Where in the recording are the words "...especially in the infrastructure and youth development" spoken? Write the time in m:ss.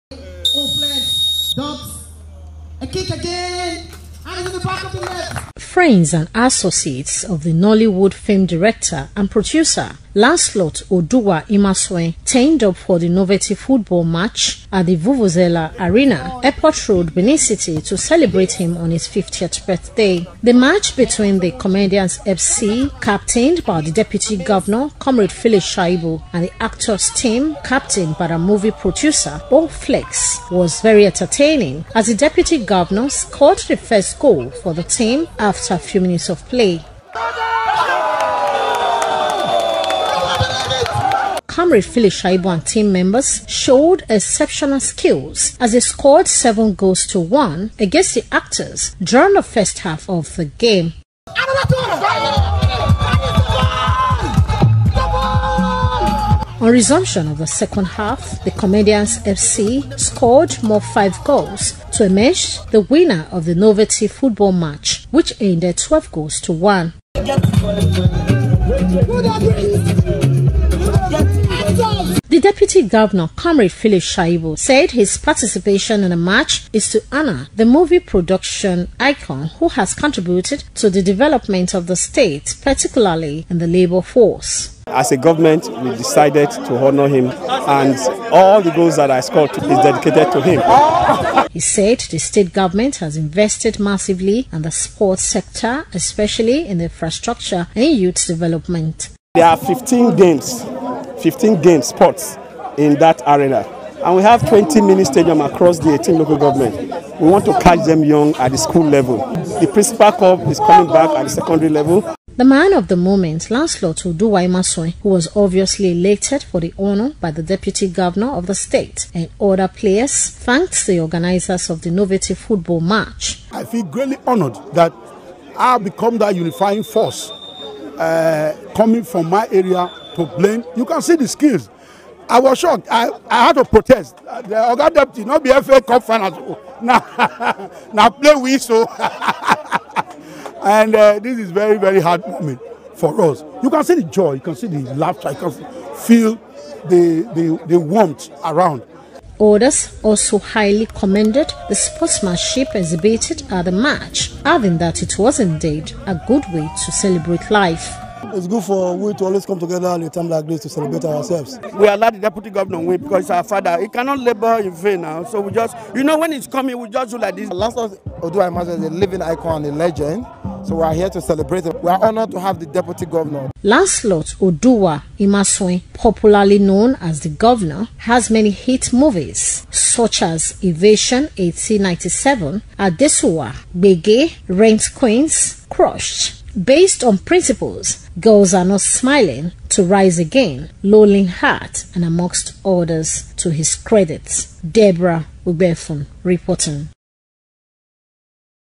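1:35.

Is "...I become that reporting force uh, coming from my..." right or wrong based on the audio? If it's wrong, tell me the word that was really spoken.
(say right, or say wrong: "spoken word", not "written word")
wrong: "unifying", not "reporting".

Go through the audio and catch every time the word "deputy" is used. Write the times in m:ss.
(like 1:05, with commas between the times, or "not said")
0:23, 0:32, 1:57, 2:14, 2:42, 2:52.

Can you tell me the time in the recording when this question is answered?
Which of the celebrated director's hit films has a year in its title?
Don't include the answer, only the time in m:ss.
3:00.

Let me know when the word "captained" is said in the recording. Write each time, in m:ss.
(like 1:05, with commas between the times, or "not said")
0:23, 0:27.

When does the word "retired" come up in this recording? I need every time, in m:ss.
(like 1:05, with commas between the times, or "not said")
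not said.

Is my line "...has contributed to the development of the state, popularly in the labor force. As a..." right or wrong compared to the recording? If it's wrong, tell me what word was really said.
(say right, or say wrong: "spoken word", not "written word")
wrong: "particularly", not "popularly".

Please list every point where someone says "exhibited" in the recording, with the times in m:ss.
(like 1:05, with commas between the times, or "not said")
2:32.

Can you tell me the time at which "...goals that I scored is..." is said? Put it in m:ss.
1:28.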